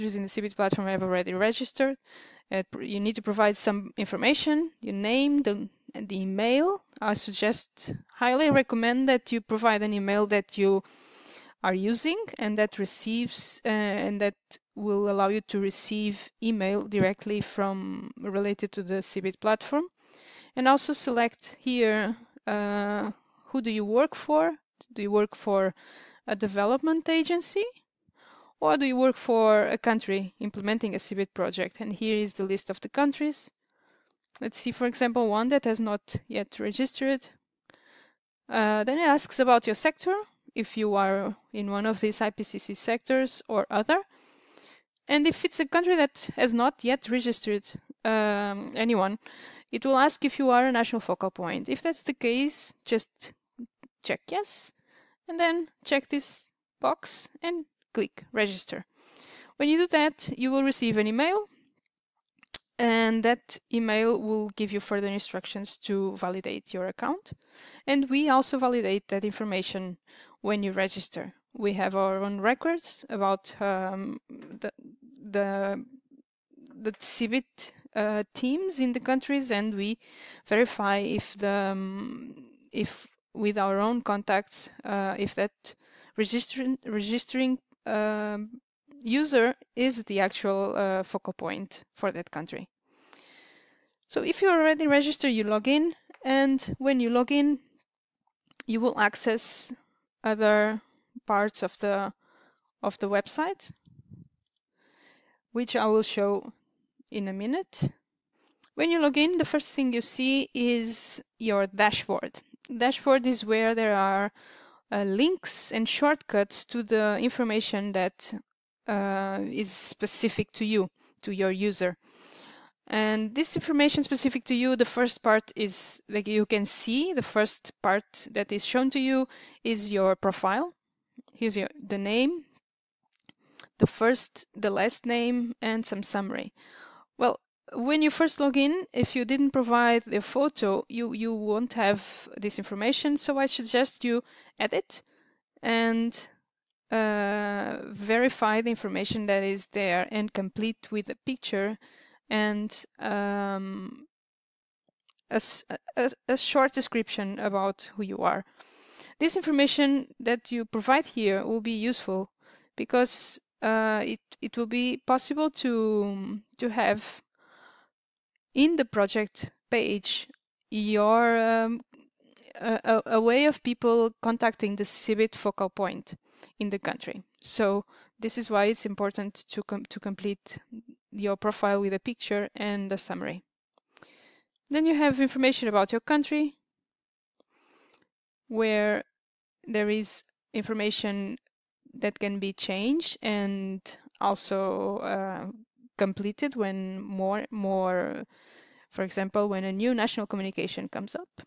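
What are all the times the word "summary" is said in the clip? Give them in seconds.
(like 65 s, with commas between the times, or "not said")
136 s, 182 s.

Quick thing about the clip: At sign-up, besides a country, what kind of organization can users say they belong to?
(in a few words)
Development agency.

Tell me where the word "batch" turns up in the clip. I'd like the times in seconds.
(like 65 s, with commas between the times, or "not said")
not said.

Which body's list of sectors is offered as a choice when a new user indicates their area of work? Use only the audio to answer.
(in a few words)
IPCC.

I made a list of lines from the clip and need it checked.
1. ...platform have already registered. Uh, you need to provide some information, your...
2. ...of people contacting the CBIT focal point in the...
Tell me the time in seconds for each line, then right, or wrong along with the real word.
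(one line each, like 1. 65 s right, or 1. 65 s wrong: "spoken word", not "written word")
1. 0 s right
2. 173 s right.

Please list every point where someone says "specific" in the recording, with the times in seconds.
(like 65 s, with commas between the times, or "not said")
119 s, 124 s.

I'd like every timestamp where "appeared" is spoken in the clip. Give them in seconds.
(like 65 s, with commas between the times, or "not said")
not said.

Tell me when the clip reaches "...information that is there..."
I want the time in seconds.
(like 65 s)
148 s.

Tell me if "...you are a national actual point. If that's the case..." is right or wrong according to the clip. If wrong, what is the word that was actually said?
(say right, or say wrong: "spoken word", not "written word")
wrong: "focal", not "actual".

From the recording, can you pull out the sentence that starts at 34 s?
Let's see, for example, one that has not yet registered.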